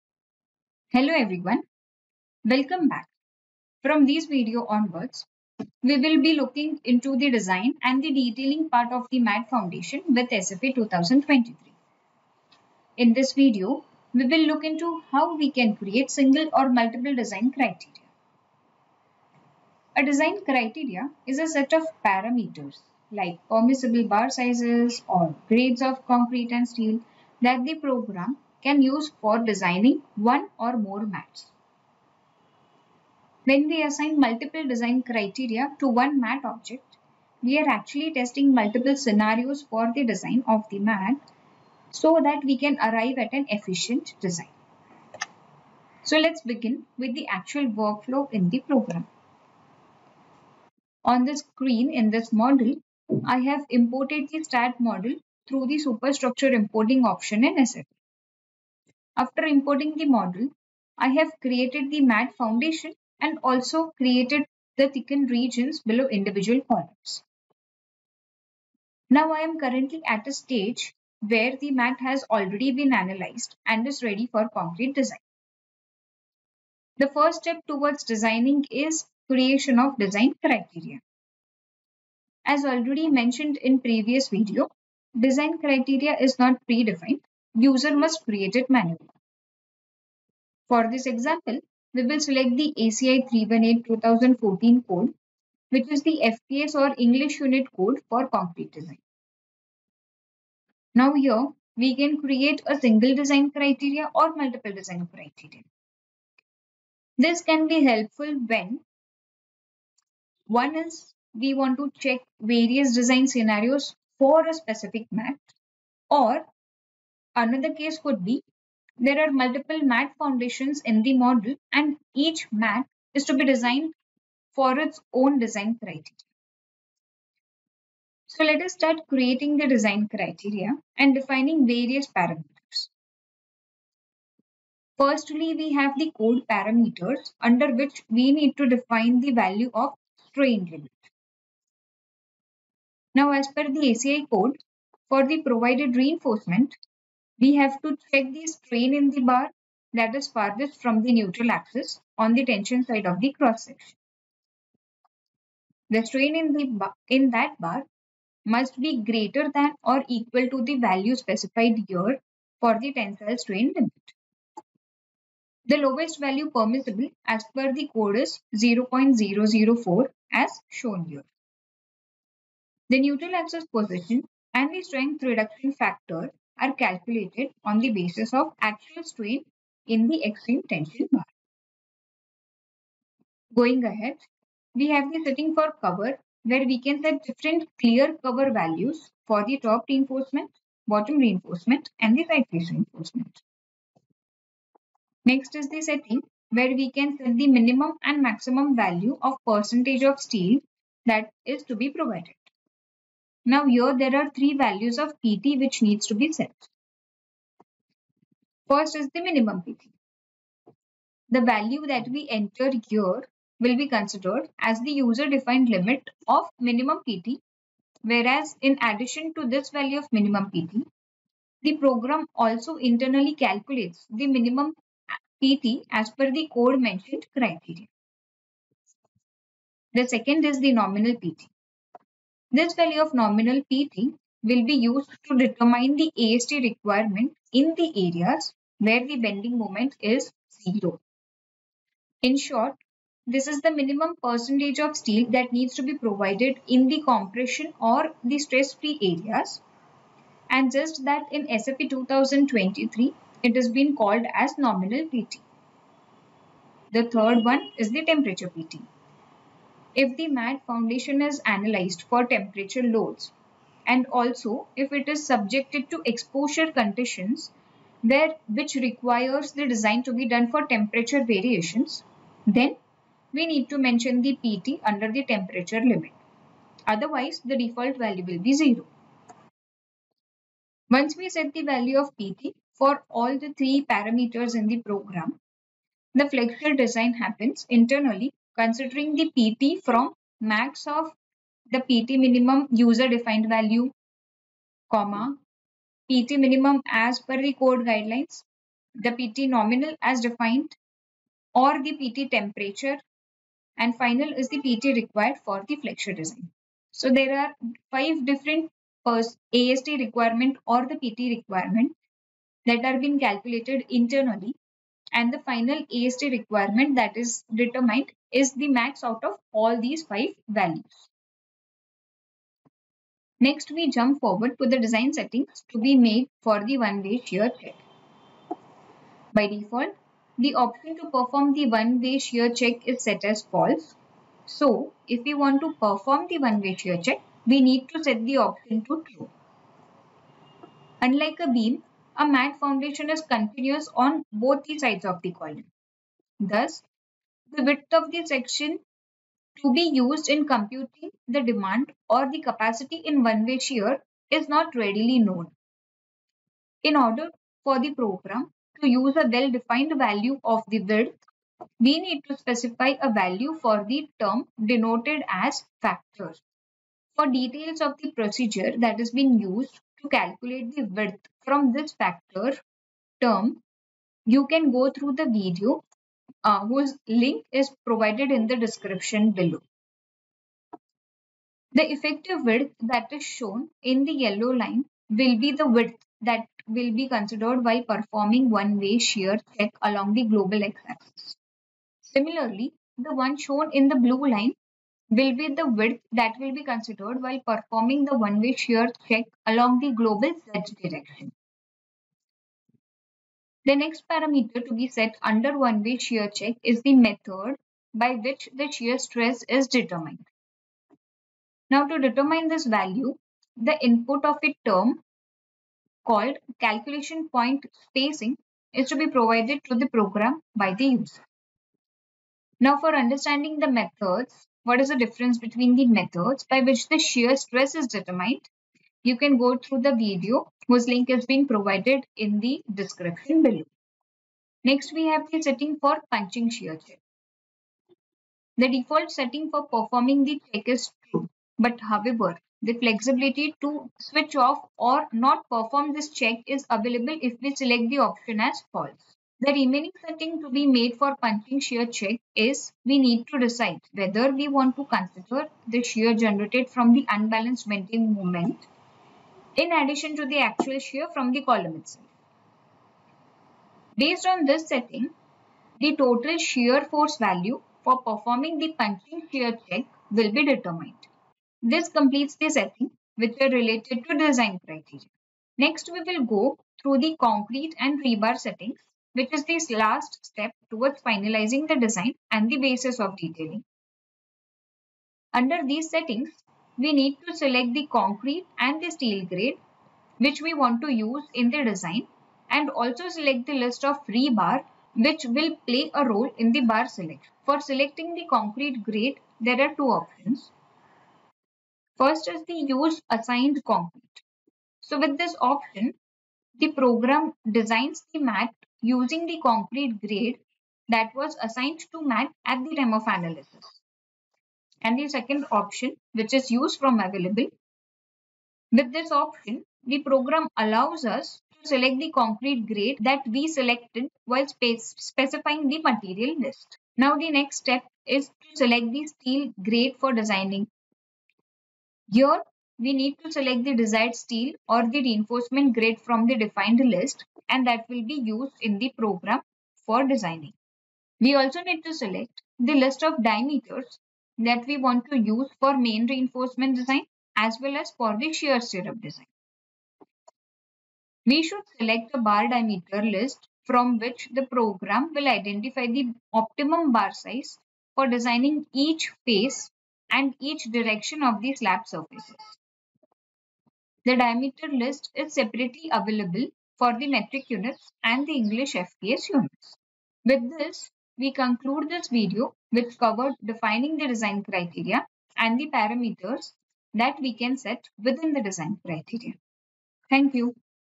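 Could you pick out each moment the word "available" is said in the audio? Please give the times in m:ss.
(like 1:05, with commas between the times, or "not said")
7:26, 8:36, 9:25.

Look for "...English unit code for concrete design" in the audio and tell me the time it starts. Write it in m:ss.
1:36.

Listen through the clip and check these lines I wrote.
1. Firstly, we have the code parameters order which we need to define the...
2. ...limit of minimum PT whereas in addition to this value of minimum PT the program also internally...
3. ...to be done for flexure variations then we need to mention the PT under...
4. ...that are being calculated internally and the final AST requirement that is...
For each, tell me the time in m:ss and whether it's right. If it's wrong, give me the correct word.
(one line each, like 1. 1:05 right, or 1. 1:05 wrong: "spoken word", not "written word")
1. 2:14 wrong: "under", not "order"
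2. 3:35 right
3. 4:30 wrong: "temperature", not "flexure"
4. 5:12 right.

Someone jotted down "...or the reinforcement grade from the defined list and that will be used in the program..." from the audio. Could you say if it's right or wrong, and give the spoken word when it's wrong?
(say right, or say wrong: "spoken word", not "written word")
right.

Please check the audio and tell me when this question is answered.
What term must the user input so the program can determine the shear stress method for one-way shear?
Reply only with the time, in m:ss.
6:56.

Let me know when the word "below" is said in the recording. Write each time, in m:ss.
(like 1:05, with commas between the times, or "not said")
1:05, 6:19, 7:13.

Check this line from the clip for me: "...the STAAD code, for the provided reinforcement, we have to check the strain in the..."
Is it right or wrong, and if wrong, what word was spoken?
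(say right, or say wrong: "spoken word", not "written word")
wrong: "ACI", not "STAAD".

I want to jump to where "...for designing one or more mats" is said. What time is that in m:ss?
0:29.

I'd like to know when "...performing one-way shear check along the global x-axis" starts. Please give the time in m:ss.
6:27.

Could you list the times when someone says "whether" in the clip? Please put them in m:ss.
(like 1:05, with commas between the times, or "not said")
7:33.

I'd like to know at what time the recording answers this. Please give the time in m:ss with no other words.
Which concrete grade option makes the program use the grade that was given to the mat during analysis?
8:22.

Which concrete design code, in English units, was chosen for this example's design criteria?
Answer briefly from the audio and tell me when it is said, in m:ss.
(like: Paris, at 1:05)
ACI 318-2014, at 1:32.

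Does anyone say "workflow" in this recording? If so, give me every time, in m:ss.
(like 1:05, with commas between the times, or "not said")
0:47.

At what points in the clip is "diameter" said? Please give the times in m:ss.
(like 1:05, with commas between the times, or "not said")
9:03, 9:12, 9:24.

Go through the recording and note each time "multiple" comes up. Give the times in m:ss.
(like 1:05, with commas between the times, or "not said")
0:16, 0:34, 0:38, 1:44, 1:59.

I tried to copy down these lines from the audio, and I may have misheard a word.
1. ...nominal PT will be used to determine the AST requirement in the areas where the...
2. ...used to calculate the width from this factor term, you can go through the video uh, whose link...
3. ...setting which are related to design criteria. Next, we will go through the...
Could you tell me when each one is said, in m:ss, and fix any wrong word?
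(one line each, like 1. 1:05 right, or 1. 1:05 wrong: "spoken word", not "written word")
1. 3:53 right
2. 6:09 right
3. 7:52 right.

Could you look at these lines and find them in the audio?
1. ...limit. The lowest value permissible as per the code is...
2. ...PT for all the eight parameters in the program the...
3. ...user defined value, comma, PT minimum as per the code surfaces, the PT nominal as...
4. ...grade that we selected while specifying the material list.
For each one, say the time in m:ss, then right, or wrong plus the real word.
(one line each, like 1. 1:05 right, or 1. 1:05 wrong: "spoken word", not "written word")
1. 2:43 right
2. 4:42 wrong: "three", not "eight"
3. 4:52 wrong: "guidelines", not "surfaces"
4. 8:42 right.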